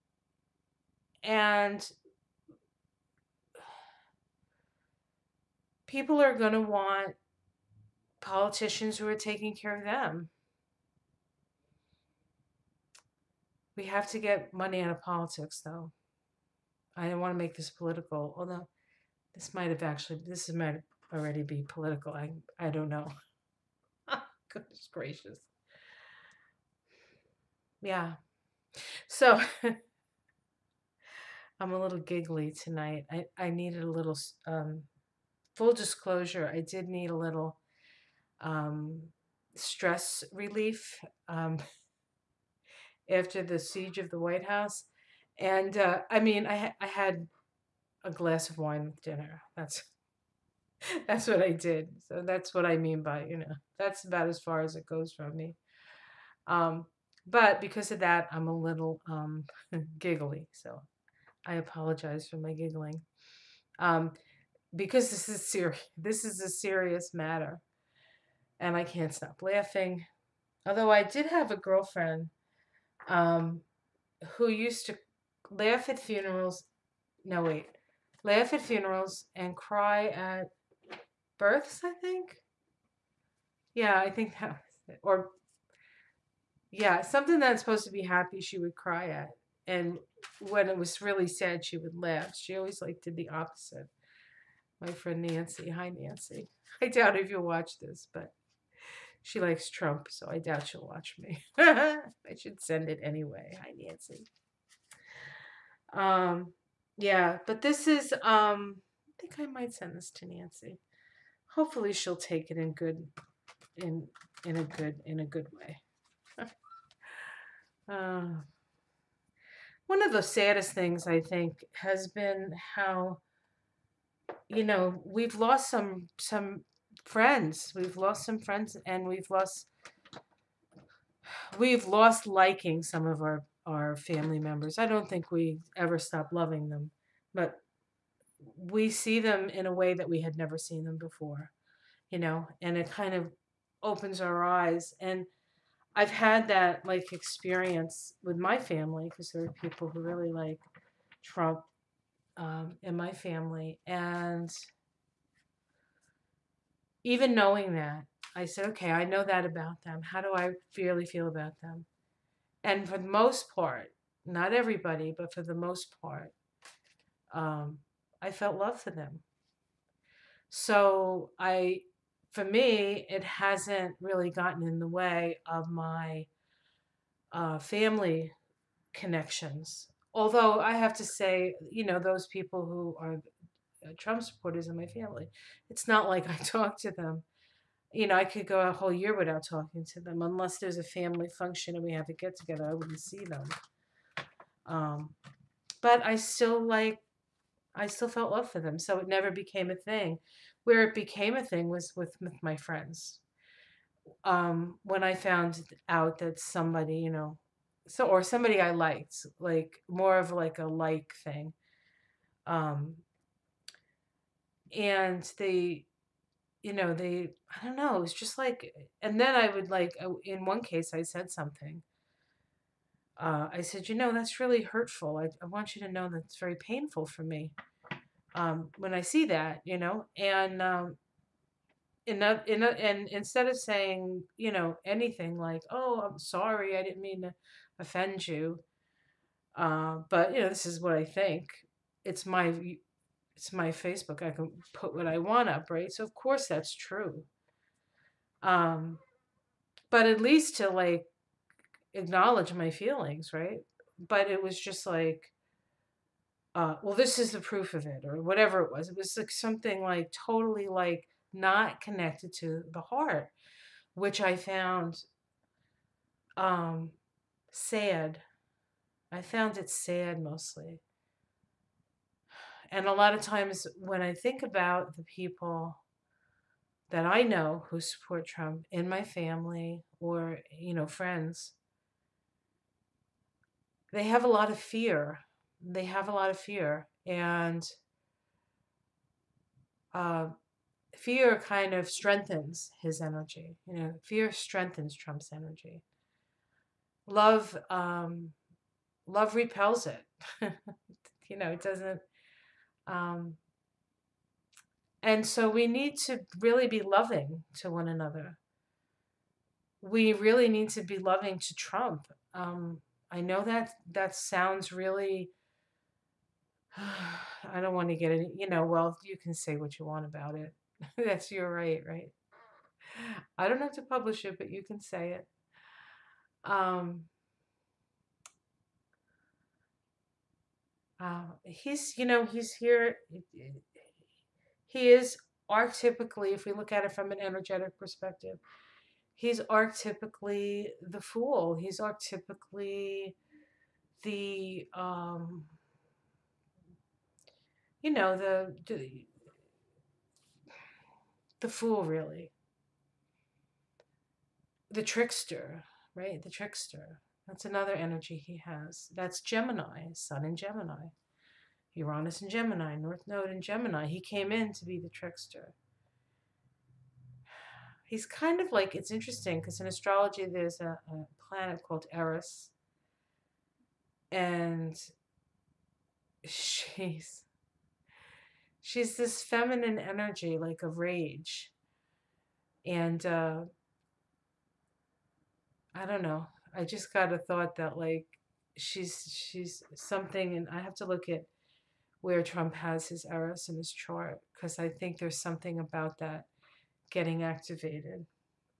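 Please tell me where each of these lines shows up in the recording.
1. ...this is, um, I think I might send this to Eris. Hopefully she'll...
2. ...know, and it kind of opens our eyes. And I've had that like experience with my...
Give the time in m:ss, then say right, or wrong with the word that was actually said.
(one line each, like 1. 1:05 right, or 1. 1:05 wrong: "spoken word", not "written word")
1. 1:47 wrong: "Nancy", not "Eris"
2. 2:22 right.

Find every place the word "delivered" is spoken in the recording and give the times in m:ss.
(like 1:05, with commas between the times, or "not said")
not said.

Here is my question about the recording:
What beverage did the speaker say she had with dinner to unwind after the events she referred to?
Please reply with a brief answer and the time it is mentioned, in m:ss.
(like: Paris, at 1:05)
A glass of wine, at 0:48.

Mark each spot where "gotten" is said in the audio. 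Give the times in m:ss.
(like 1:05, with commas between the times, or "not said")
2:54.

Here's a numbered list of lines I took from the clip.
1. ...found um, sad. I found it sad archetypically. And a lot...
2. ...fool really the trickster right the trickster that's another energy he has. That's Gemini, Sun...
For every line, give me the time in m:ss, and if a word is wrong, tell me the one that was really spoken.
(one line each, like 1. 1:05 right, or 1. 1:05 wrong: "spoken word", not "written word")
1. 4:24 wrong: "mostly", not "archetypically"
2. 5:51 right.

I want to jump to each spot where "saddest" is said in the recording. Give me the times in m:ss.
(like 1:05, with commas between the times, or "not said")
2:00.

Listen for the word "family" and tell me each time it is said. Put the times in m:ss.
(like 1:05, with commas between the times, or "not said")
2:13, 2:28, 2:33, 2:57, 3:04, 3:10, 4:39.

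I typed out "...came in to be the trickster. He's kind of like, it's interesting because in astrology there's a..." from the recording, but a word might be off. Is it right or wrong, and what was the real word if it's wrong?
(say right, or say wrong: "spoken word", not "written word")
right.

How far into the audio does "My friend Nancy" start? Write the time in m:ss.
1:34.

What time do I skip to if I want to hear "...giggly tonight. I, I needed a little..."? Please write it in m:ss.
0:31.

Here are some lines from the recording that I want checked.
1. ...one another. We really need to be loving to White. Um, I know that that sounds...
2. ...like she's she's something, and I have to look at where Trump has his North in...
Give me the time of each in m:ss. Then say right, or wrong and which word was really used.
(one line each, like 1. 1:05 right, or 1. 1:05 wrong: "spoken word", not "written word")
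1. 5:07 wrong: "Trump", not "White"
2. 6:27 wrong: "Eris", not "North".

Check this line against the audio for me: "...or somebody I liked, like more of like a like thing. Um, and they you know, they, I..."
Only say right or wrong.
right.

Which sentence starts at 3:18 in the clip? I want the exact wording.
So it never became a thing.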